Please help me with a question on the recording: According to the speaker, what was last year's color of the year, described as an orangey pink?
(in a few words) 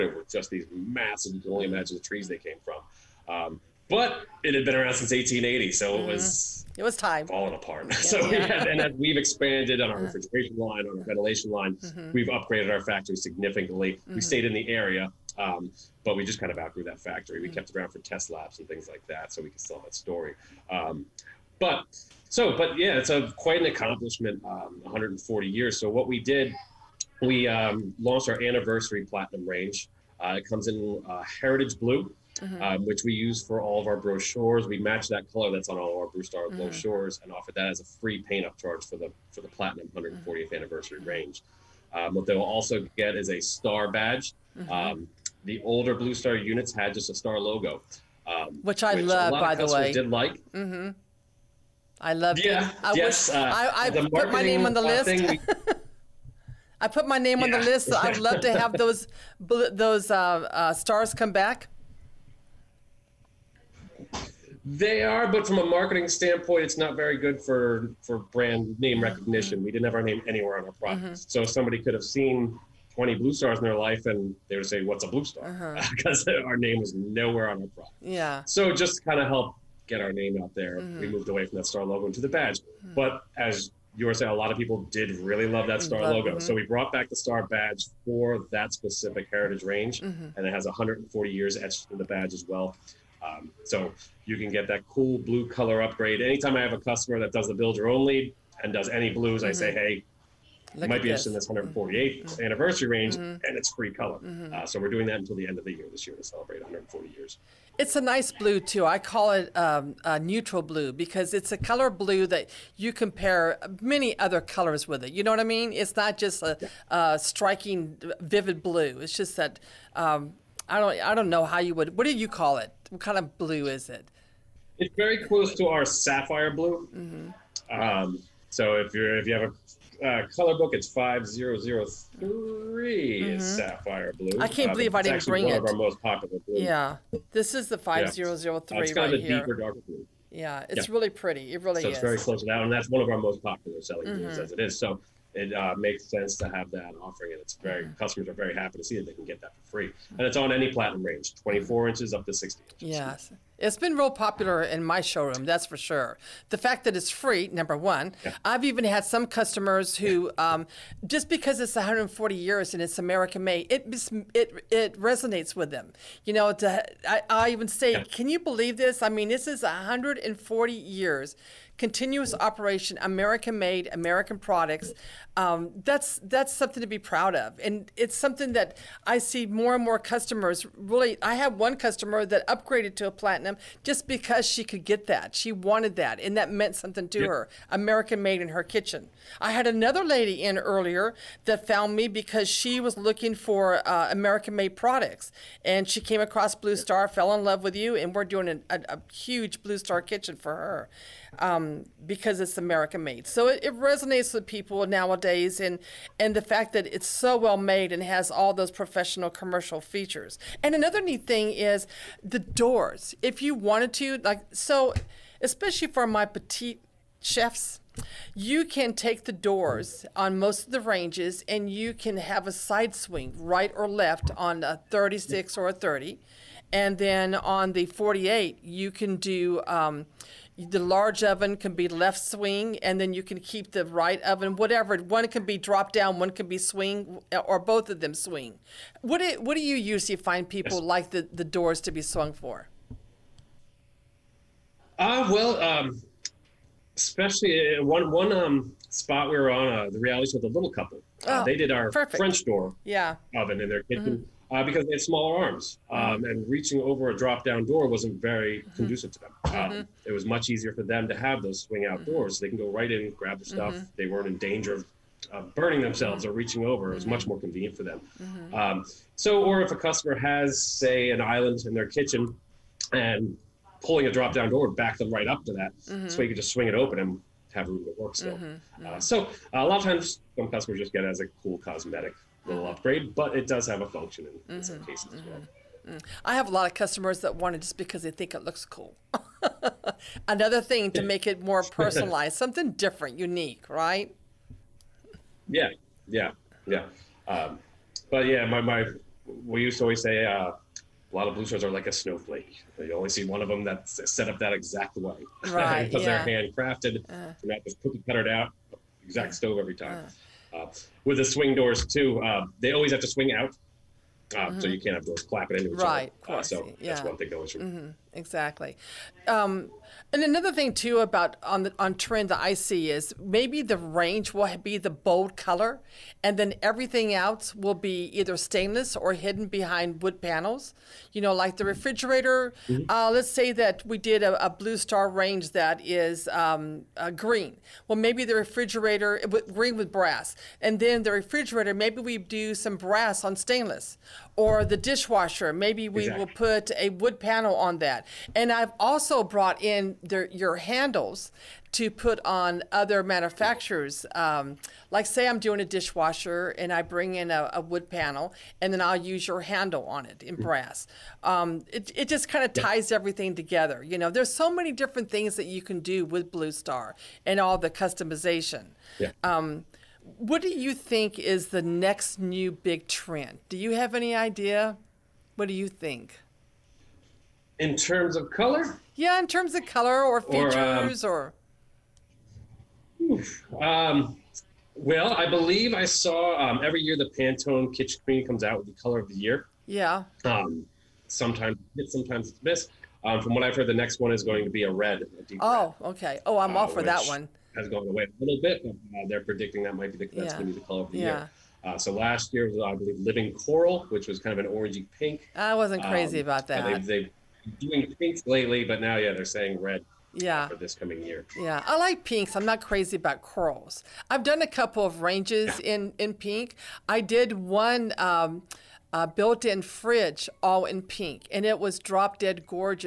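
Living coral.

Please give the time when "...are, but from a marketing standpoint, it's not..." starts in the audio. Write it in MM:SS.
01:05.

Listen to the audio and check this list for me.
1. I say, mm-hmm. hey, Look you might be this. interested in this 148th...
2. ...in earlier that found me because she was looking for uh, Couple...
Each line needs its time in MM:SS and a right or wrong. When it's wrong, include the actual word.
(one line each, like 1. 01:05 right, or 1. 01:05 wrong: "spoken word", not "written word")
1. 01:39 right
2. 03:10 wrong: "American", not "Couple".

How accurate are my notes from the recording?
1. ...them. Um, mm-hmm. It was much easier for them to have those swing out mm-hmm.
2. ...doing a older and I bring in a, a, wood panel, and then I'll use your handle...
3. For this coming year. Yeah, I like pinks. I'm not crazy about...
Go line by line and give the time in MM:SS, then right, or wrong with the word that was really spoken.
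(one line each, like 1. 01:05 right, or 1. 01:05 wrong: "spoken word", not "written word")
1. 04:19 right
2. 05:55 wrong: "dishwasher", not "older"
3. 06:50 right.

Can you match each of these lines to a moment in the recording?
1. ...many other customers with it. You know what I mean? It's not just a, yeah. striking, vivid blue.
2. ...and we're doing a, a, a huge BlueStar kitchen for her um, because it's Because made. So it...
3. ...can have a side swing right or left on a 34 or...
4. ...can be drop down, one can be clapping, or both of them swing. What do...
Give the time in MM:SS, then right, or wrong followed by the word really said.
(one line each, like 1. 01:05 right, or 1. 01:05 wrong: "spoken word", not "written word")
1. 01:53 wrong: "colors", not "customers"
2. 03:17 wrong: "American", not "Because"
3. 03:41 wrong: "36", not "34"
4. 03:55 wrong: "swing", not "clapping".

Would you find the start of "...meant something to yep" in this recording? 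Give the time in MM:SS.
03:06.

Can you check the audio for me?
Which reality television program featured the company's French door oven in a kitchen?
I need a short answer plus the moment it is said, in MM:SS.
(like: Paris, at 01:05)
The Little Couple, at 04:10.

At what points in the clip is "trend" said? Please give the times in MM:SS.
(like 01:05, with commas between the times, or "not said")
05:21, 06:12.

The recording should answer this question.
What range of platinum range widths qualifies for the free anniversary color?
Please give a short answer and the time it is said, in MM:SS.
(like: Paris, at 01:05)
24 to 60 inches, at 02:31.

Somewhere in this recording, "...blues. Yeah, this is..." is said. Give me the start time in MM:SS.
02:16.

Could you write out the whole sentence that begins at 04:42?
upgrade, but it does have a function in, in some mm-hmm.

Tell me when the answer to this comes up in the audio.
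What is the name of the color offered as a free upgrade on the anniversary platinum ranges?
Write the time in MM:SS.
00:31.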